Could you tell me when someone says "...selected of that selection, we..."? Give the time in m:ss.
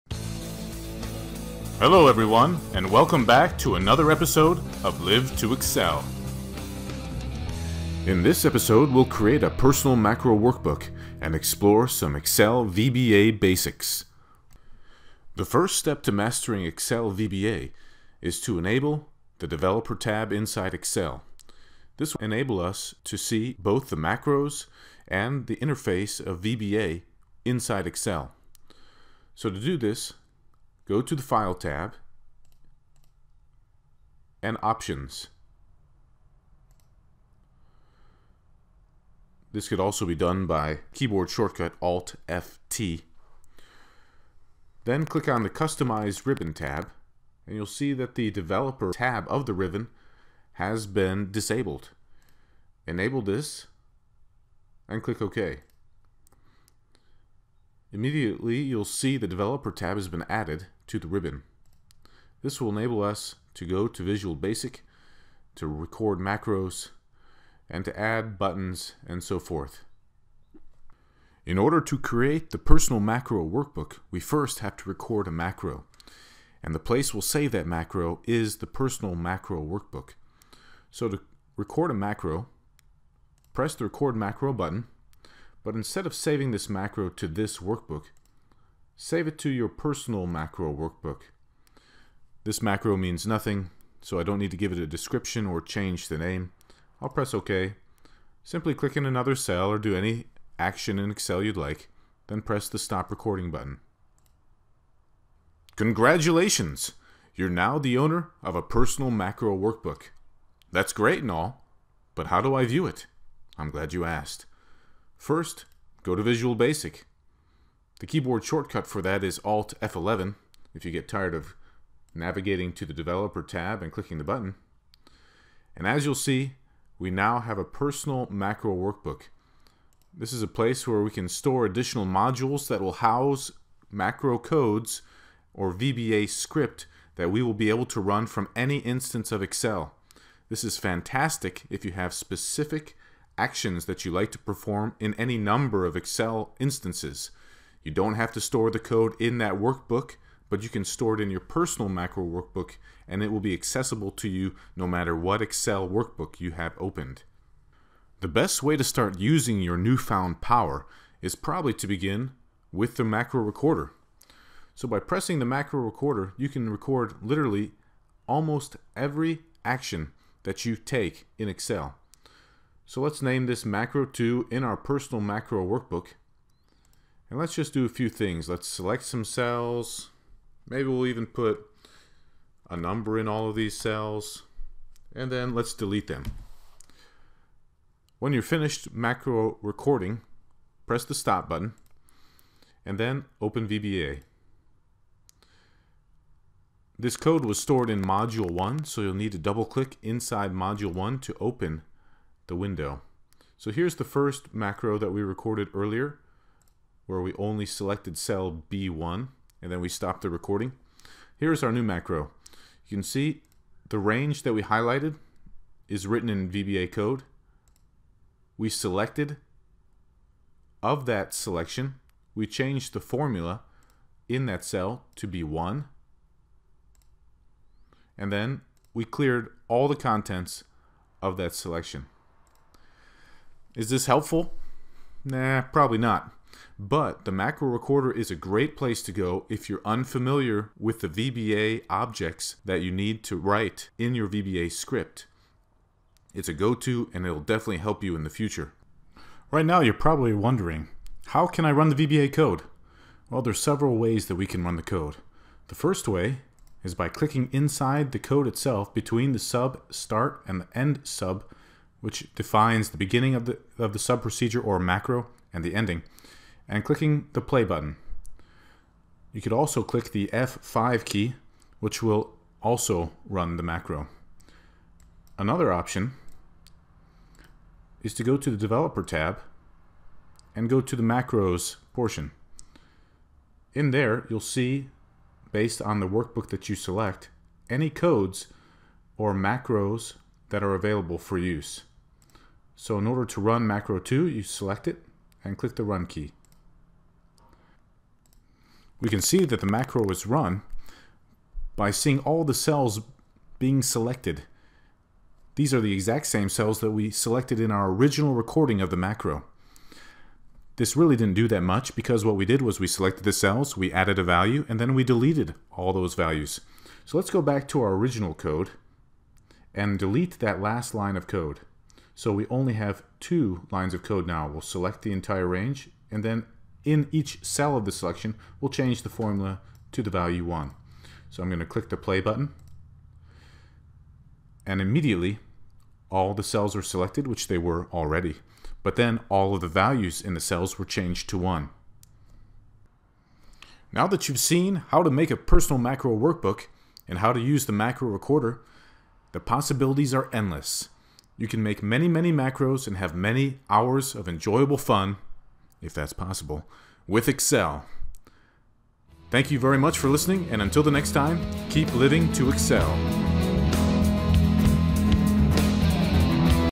3:38.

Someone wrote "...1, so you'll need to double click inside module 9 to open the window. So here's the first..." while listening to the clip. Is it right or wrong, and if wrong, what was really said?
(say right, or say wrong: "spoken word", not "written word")
wrong: "1", not "9".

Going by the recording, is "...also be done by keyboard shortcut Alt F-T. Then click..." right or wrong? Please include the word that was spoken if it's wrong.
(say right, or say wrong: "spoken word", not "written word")
right.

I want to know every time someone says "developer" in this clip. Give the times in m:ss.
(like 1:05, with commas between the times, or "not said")
0:19, 0:48, 0:59, 2:02, 4:38.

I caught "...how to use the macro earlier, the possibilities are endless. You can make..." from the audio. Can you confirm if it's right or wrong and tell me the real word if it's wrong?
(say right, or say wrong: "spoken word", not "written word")
wrong: "recorder", not "earlier".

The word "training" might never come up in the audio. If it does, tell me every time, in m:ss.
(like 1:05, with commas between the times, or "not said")
not said.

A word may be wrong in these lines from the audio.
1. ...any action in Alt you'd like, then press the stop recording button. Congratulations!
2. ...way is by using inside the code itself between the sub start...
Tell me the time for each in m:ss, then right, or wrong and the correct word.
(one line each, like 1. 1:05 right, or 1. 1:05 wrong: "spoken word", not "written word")
1. 1:39 wrong: "Excel", not "Alt"
2. 4:16 wrong: "clicking", not "using".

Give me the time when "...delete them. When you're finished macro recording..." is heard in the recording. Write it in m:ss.
3:05.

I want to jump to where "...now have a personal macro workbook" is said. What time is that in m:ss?
2:07.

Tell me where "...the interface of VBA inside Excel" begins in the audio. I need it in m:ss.
0:25.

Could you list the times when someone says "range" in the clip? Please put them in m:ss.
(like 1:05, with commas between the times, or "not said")
3:33, 5:25.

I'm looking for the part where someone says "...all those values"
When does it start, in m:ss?
5:15.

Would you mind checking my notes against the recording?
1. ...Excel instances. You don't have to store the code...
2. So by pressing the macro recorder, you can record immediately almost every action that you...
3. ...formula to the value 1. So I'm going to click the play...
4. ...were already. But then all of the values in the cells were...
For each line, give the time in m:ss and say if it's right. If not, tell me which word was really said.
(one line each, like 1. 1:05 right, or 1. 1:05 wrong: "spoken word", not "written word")
1. 2:25 right
2. 2:44 wrong: "literally", not "immediately"
3. 5:29 right
4. 5:37 right.